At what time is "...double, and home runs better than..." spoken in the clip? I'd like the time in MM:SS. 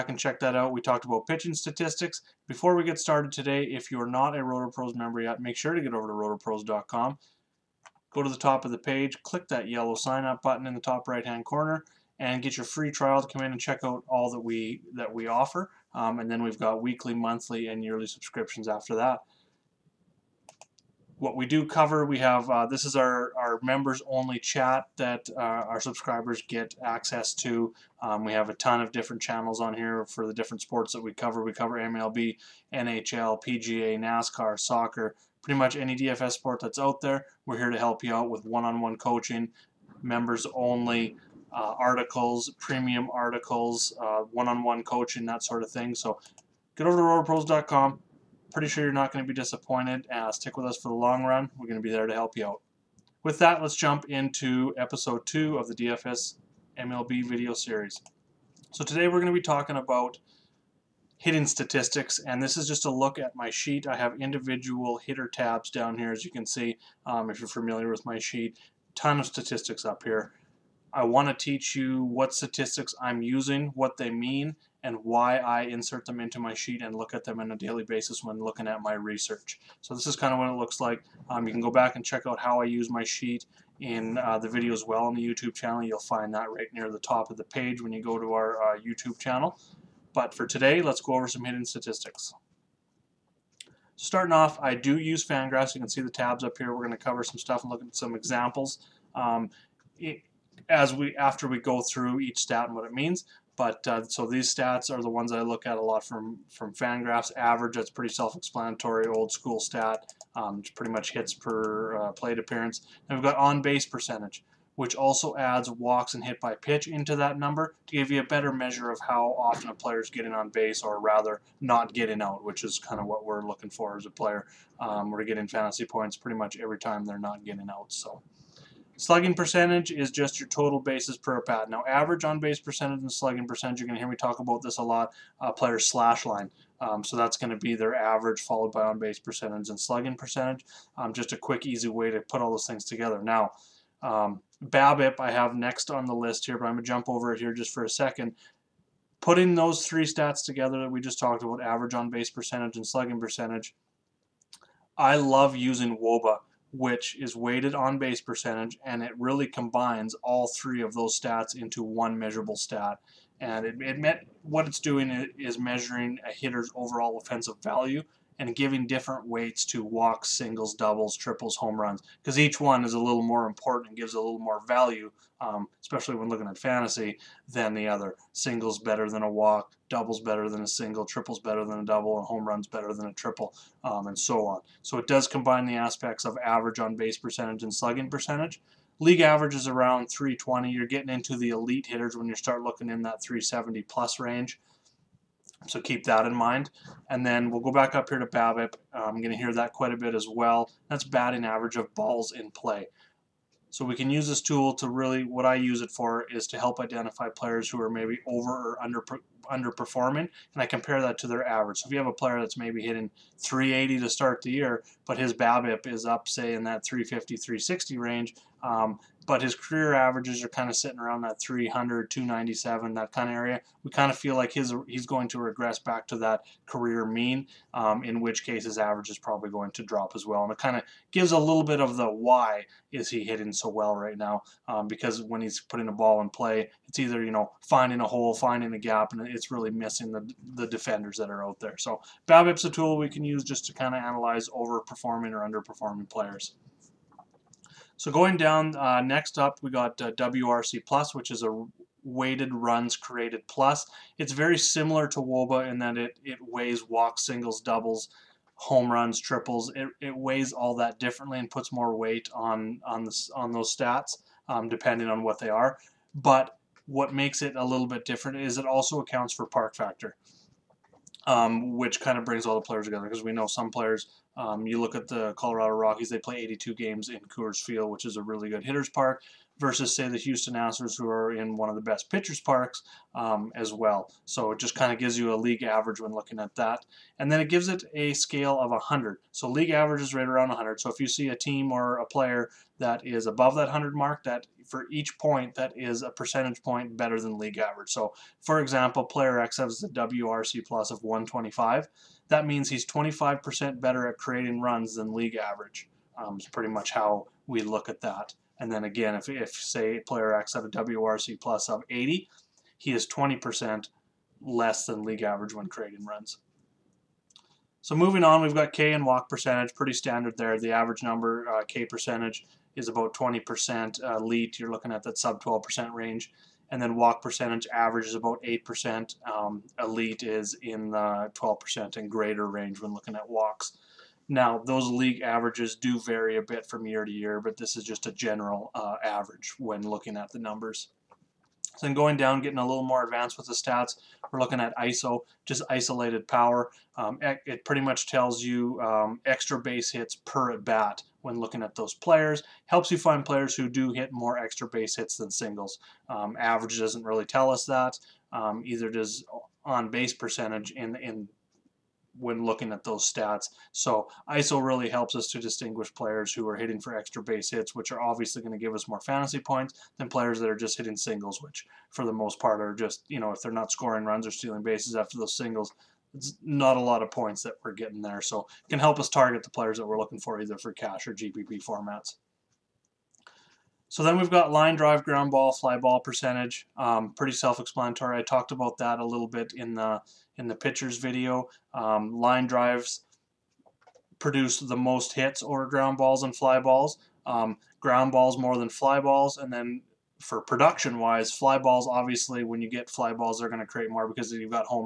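03:01.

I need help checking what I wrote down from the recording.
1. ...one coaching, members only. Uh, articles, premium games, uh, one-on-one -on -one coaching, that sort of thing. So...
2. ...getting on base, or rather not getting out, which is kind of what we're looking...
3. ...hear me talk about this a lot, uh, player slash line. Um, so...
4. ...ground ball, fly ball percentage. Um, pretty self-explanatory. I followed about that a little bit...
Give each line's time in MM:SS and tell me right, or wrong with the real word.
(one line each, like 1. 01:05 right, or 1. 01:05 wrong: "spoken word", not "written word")
1. 00:38 wrong: "articles", not "games"
2. 02:00 right
3. 02:13 right
4. 06:25 wrong: "talked", not "followed".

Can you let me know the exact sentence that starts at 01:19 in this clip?
So this is kind of what it looks like.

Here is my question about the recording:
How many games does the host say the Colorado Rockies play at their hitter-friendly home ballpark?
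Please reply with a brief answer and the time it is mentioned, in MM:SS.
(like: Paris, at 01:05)
82, at 04:36.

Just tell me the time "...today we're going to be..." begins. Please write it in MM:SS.
00:58.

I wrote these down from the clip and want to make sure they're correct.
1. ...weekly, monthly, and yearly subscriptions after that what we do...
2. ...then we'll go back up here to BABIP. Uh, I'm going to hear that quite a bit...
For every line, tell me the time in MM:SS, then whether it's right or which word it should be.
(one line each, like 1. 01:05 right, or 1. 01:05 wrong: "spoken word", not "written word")
1. 00:16 right
2. 03:17 right.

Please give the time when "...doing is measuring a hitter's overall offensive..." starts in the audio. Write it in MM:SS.
02:44.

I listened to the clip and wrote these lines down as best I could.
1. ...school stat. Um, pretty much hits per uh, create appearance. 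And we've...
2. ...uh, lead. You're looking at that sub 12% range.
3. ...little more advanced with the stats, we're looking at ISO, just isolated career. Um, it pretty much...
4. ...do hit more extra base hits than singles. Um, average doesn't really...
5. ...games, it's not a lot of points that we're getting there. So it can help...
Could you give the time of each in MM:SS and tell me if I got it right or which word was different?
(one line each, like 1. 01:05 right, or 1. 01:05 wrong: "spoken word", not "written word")
1. 01:49 wrong: "plate", not "create"
2. 05:24 right
3. 05:42 wrong: "power", not "career"
4. 05:53 right
5. 06:15 wrong: "singles", not "games".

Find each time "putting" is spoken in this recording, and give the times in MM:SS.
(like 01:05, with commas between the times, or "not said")
02:29, 03:55.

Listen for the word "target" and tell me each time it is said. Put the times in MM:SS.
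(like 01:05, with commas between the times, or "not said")
06:19.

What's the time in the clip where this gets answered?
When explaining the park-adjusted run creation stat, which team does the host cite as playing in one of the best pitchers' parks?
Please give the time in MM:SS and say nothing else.
04:40.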